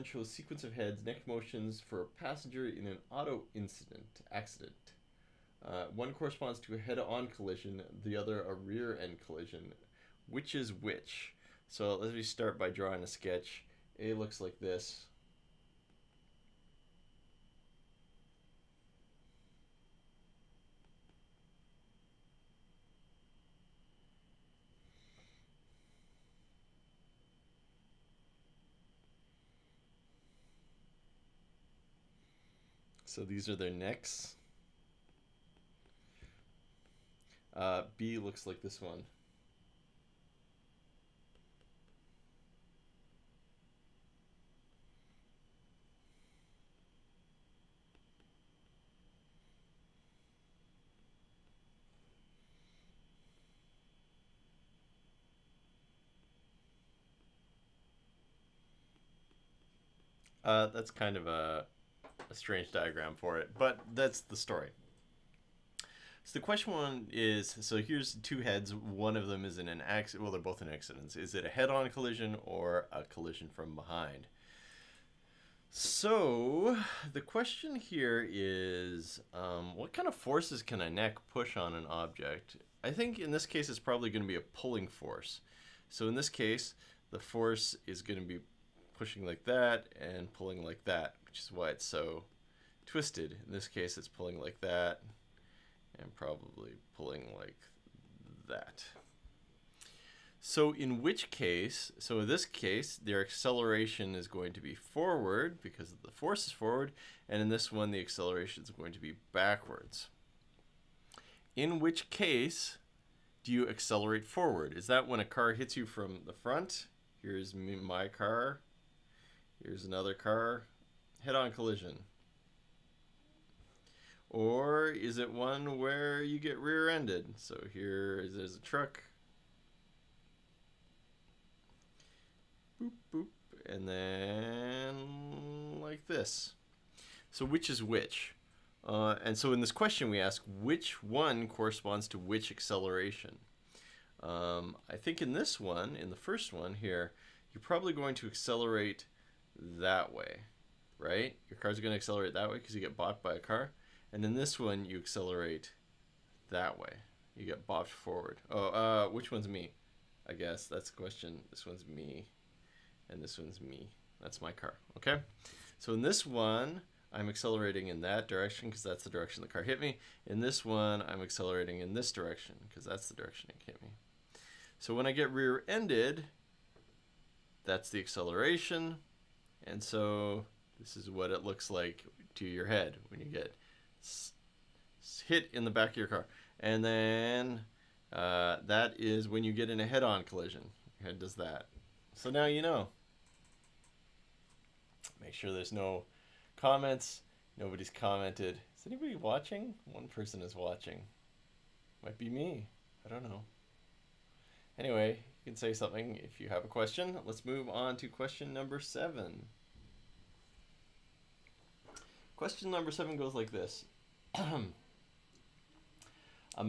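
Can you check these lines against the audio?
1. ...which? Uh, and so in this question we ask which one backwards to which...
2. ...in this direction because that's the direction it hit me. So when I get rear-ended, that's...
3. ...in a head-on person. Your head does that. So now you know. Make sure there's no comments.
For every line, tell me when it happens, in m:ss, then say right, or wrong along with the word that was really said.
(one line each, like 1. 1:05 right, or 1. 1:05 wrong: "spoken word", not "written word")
1. 2:17 wrong: "corresponds", not "backwards"
2. 2:51 right
3. 3:09 wrong: "collision", not "person".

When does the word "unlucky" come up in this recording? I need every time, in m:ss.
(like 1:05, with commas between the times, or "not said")
not said.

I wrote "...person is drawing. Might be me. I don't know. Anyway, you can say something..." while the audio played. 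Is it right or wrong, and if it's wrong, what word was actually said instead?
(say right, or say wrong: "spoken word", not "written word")
wrong: "watching", not "drawing".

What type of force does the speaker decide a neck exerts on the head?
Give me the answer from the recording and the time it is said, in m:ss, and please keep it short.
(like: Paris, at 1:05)
pulling force, at 1:24.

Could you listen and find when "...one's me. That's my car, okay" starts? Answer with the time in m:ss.
2:43.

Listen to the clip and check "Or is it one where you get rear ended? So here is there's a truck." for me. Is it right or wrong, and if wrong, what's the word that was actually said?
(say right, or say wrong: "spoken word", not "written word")
right.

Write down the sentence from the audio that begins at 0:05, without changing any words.
Uh, one corresponds to a head-on collision, the other a rear-end collision.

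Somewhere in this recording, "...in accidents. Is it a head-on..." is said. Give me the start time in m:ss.
1:10.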